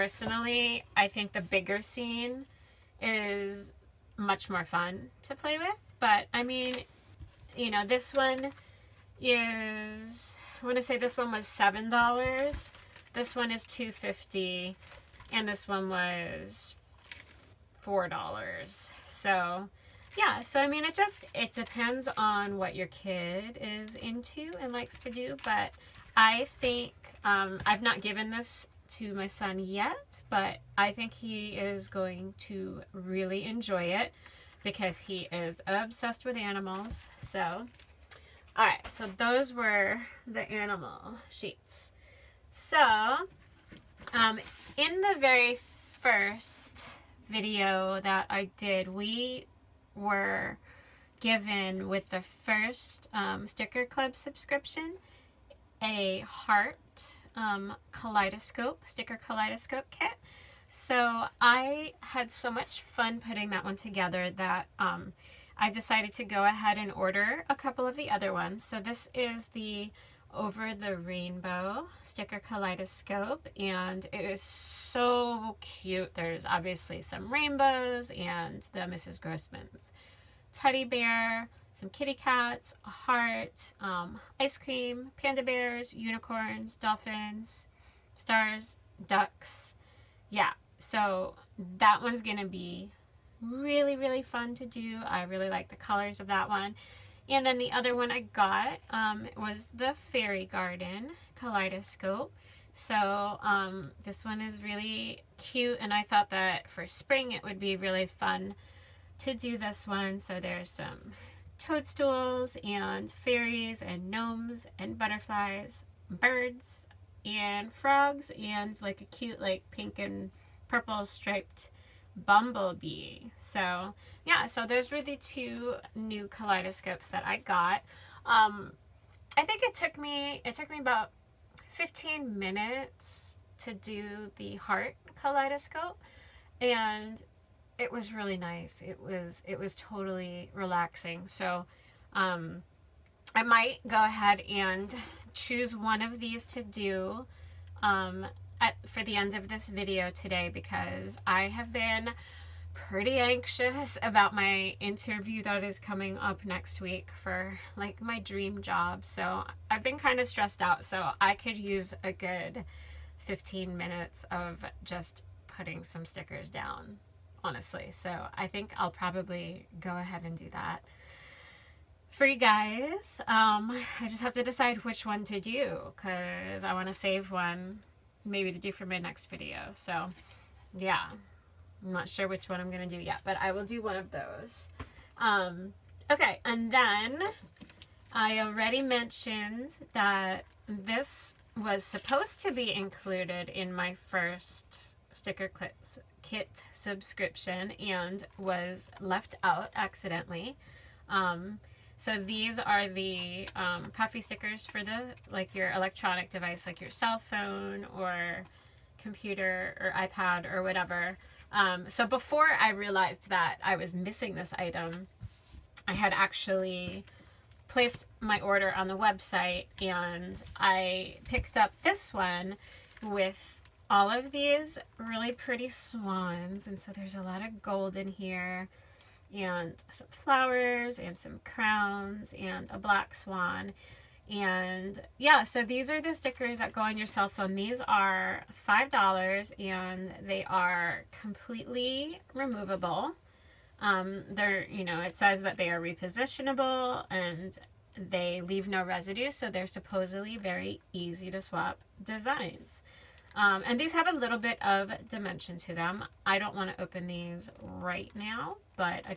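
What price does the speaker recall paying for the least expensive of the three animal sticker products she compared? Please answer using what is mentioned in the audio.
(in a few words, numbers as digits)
$2.50.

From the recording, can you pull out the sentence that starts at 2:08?
Um, I think it took me, it took me about 15 minutes to do the heart kaleidoscope and it was really nice.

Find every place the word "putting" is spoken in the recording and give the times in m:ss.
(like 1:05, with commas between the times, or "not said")
1:03, 2:45.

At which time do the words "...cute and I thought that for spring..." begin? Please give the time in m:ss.
1:45.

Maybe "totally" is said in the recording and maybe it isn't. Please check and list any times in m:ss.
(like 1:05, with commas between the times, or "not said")
2:19.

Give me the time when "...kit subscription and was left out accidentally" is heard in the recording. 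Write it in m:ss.
3:16.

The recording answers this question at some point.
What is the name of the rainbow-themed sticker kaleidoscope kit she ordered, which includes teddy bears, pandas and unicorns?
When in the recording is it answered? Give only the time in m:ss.
1:10.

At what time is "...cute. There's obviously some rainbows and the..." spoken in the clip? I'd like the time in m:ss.
1:15.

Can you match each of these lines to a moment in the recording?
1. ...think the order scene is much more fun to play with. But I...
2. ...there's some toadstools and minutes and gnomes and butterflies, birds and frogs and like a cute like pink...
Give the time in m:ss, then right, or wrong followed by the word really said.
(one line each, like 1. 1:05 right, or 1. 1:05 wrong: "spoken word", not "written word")
1. 0:01 wrong: "bigger", not "order"
2. 1:50 wrong: "fairies", not "minutes".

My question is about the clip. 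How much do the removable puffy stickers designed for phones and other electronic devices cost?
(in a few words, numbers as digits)
$5.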